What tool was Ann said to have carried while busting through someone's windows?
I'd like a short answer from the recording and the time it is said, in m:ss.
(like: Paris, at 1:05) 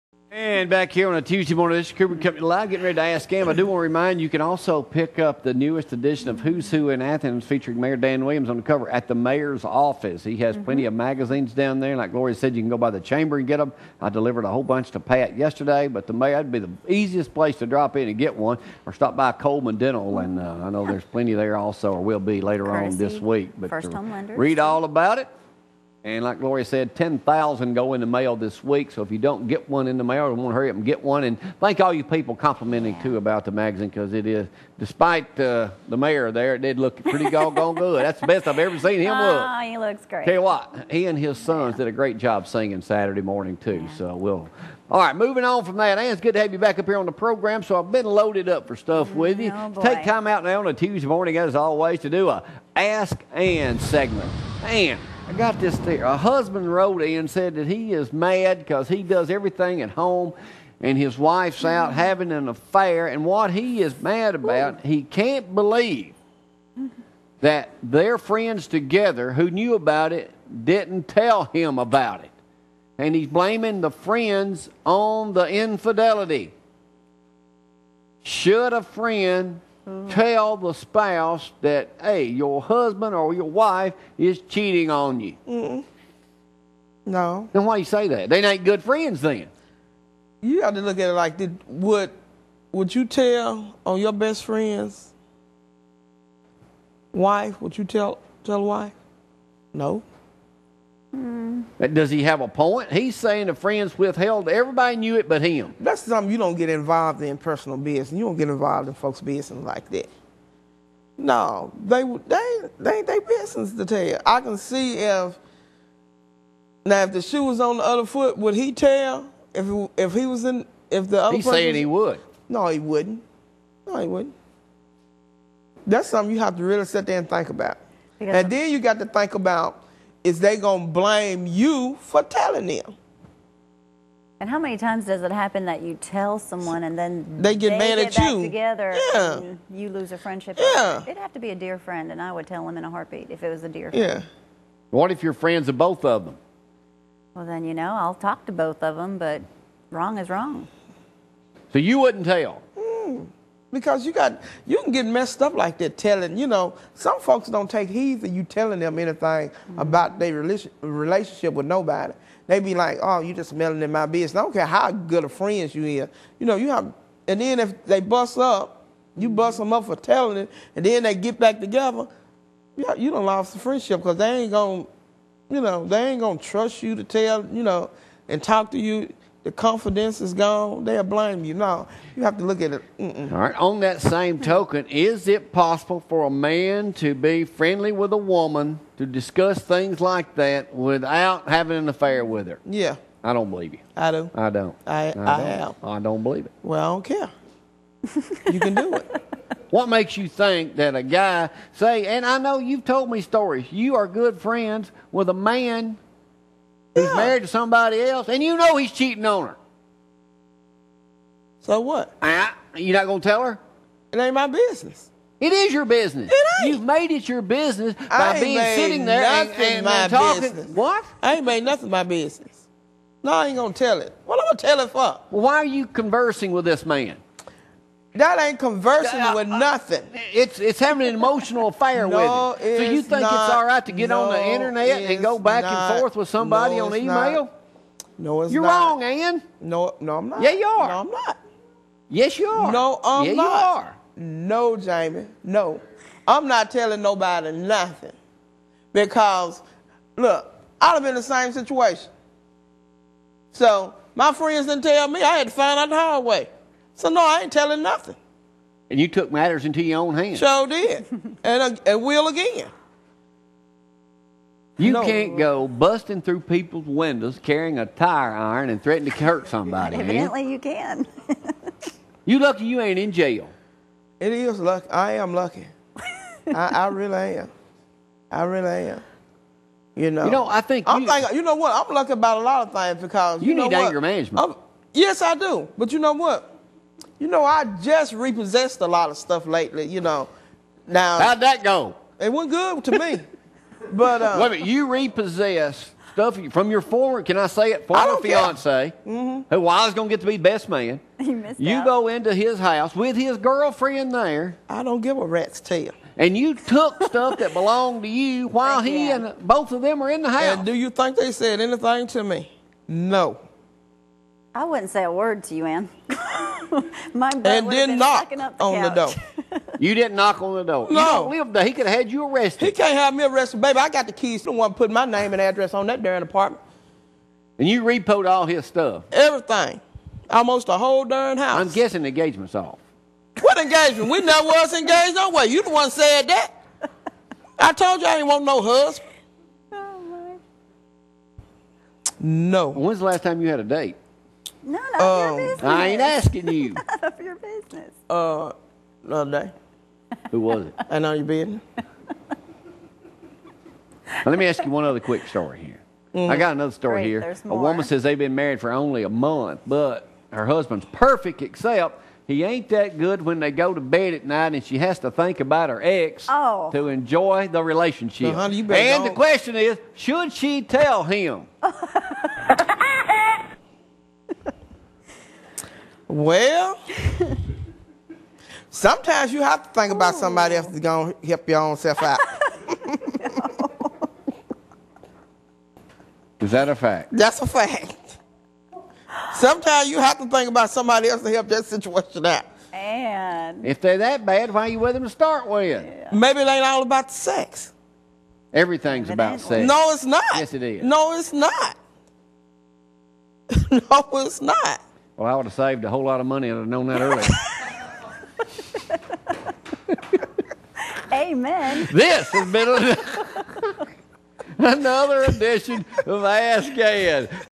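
tire iron, at 4:27.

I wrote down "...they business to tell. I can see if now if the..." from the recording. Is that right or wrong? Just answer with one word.
right.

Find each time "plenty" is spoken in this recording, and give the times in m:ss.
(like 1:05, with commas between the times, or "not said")
0:10, 0:21.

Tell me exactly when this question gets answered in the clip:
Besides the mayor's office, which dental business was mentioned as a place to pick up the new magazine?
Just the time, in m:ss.
0:19.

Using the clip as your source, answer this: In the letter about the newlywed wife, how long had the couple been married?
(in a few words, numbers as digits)
a month.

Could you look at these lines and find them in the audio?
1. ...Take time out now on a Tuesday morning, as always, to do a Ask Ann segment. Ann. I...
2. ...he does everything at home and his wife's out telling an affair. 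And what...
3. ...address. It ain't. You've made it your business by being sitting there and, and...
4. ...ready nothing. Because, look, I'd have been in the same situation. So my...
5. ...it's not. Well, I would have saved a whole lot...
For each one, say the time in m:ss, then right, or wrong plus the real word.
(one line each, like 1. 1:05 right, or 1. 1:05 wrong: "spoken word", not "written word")
1. 0:49 right
2. 0:58 wrong: "having", not "telling"
3. 3:35 wrong: "business", not "address"
4. 4:07 wrong: "nobody", not "ready"
5. 6:44 right.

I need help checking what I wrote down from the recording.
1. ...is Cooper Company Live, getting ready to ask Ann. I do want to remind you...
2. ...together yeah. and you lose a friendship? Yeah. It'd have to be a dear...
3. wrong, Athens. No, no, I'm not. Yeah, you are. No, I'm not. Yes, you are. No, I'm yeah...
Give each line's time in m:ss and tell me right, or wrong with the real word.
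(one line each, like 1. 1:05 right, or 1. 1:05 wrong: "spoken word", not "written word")
1. 0:01 right
2. 2:18 right
3. 3:58 wrong: "Ann", not "Athens".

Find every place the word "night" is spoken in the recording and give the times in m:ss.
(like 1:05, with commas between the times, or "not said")
6:04.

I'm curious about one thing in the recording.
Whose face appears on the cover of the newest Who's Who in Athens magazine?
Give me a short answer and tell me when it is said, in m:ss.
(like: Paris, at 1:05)
Mayor Dan Williams, at 0:07.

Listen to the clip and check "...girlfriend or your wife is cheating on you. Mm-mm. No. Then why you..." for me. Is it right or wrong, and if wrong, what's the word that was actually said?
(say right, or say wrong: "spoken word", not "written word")
wrong: "husband", not "girlfriend".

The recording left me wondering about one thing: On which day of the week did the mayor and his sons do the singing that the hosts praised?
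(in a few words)
Saturday.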